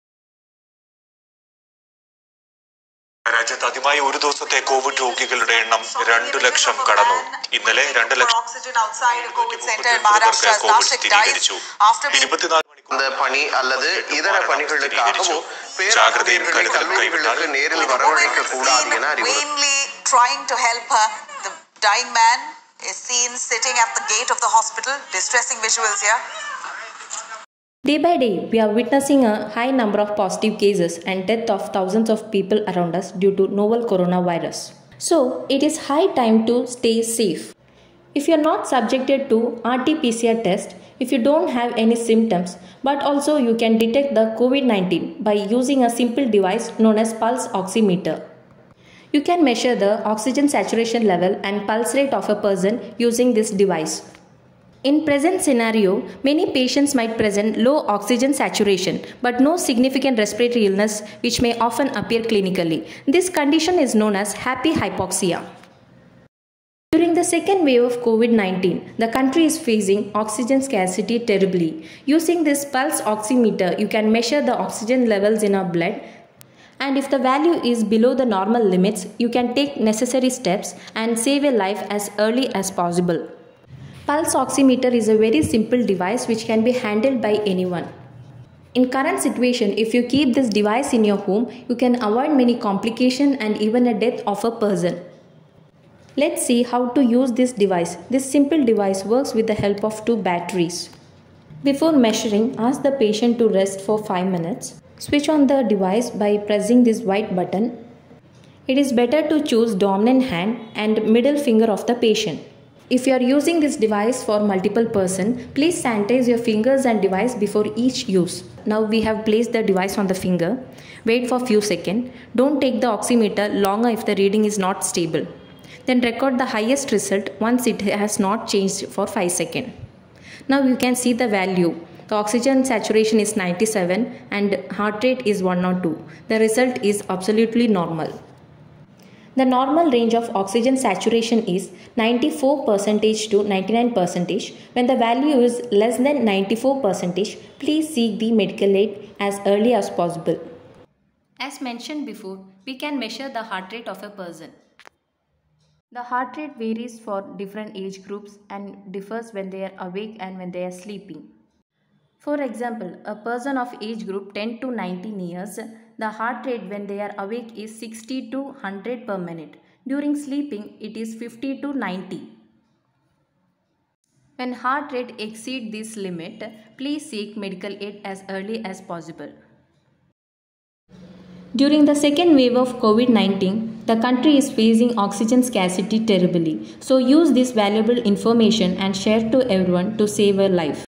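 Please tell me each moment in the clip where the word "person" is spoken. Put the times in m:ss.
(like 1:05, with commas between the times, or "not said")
0:52, 1:34, 1:54, 2:34, 2:43.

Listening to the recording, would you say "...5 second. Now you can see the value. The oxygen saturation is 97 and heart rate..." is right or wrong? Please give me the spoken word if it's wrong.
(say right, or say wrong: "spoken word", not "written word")
right.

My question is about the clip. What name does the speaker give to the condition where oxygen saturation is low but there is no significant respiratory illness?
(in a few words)
happy hypoxia.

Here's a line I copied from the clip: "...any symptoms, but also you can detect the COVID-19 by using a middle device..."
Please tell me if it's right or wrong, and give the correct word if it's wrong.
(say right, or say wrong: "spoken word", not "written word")
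wrong: "simple", not "middle".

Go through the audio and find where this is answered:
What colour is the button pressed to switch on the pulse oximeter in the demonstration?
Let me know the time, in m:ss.
1:46.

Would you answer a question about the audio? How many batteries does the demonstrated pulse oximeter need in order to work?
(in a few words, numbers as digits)
2.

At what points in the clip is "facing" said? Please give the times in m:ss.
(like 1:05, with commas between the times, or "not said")
1:09, 3:04.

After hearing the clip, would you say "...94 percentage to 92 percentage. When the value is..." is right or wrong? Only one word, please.
wrong.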